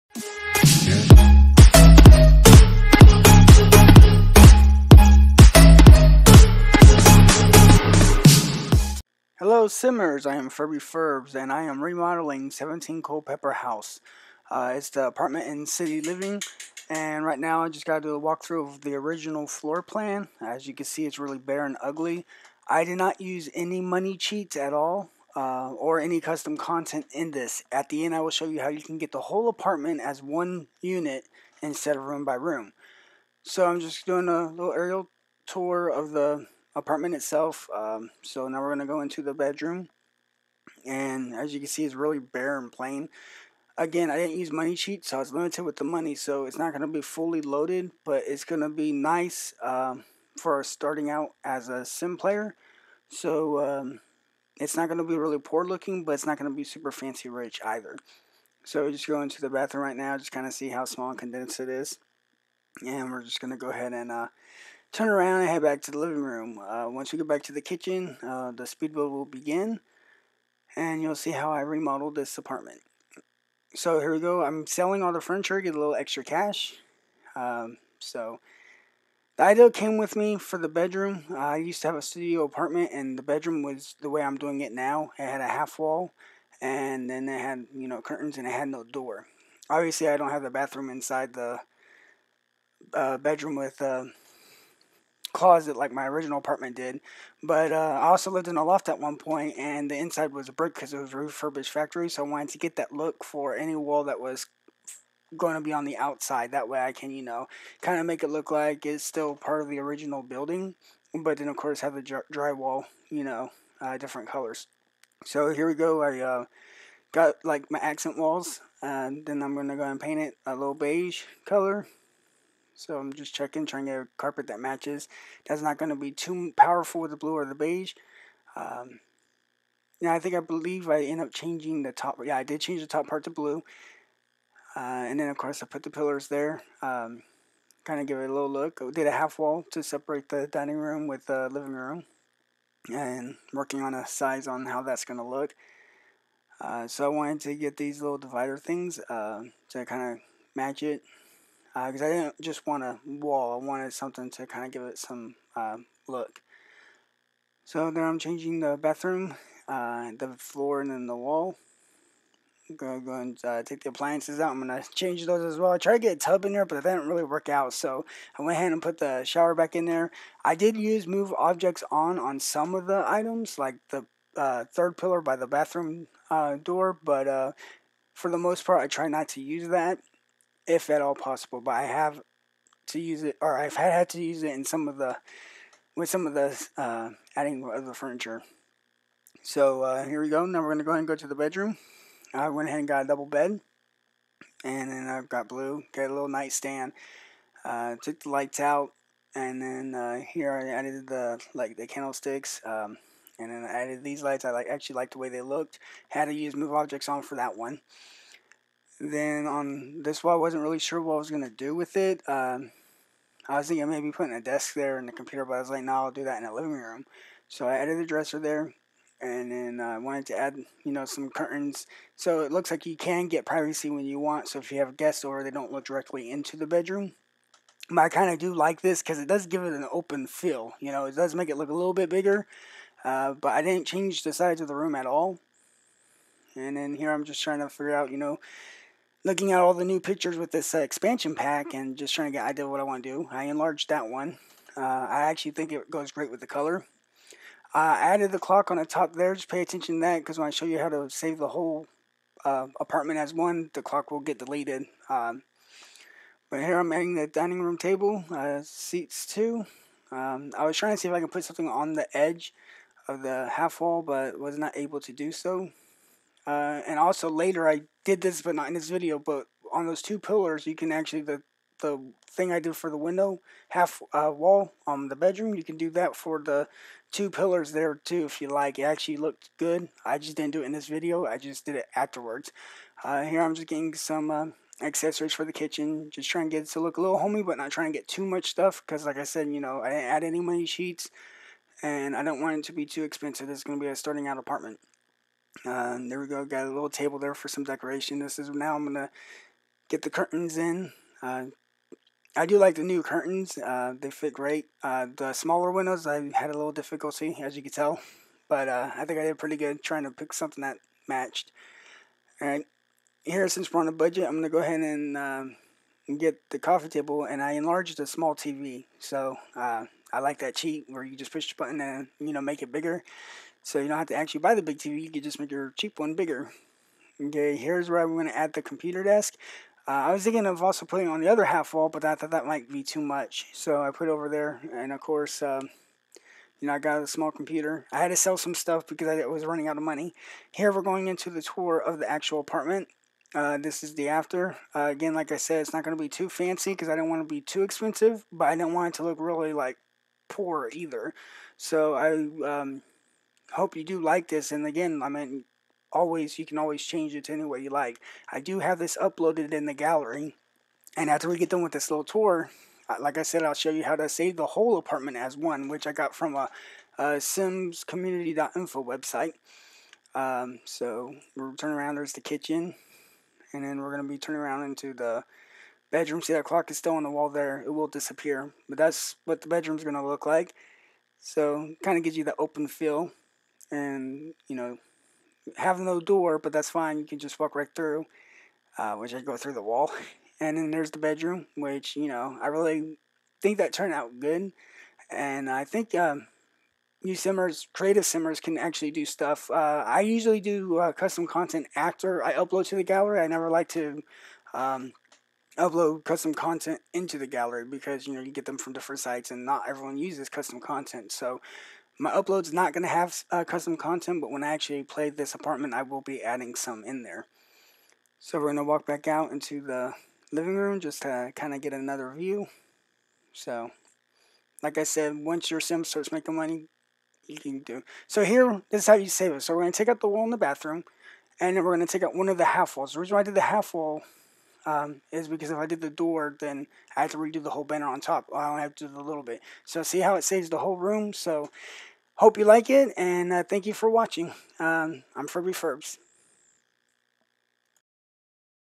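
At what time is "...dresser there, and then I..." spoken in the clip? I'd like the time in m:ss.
3:38.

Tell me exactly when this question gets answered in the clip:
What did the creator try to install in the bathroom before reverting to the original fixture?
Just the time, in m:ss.
2:46.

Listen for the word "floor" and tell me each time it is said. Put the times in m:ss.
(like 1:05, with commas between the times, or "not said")
0:19, 2:40.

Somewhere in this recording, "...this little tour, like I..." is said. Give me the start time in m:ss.
6:01.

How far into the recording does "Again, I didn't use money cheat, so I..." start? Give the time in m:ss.
0:43.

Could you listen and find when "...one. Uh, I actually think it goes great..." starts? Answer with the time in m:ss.
4:04.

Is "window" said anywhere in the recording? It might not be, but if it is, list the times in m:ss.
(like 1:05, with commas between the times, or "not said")
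4:32, 5:05.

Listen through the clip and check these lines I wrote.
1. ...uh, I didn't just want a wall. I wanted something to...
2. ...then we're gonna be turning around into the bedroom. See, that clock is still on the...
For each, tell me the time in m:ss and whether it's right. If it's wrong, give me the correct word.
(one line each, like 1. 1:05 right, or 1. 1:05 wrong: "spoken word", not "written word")
1. 2:32 right
2. 6:13 right.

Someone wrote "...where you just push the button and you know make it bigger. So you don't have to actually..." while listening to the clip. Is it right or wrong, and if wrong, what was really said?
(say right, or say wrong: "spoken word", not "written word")
right.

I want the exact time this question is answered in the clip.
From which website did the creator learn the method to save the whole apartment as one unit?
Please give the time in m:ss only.
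6:07.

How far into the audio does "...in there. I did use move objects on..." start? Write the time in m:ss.
2:49.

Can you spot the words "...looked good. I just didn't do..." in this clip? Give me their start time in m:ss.
4:39.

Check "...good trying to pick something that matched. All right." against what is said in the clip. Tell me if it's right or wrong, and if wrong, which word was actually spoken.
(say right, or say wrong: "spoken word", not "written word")
right.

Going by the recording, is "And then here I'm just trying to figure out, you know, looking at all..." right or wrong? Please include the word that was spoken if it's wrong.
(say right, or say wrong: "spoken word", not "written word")
right.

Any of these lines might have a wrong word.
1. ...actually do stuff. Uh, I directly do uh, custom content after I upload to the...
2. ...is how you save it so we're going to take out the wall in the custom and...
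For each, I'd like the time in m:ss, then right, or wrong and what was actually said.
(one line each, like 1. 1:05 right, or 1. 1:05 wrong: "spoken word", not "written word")
1. 6:38 wrong: "usually", not "directly"
2. 7:08 wrong: "bathroom", not "custom".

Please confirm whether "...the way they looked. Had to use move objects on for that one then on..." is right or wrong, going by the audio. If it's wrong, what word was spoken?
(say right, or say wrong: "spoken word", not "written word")
right.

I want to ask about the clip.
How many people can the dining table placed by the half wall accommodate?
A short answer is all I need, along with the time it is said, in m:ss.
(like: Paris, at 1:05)
2, at 4:18.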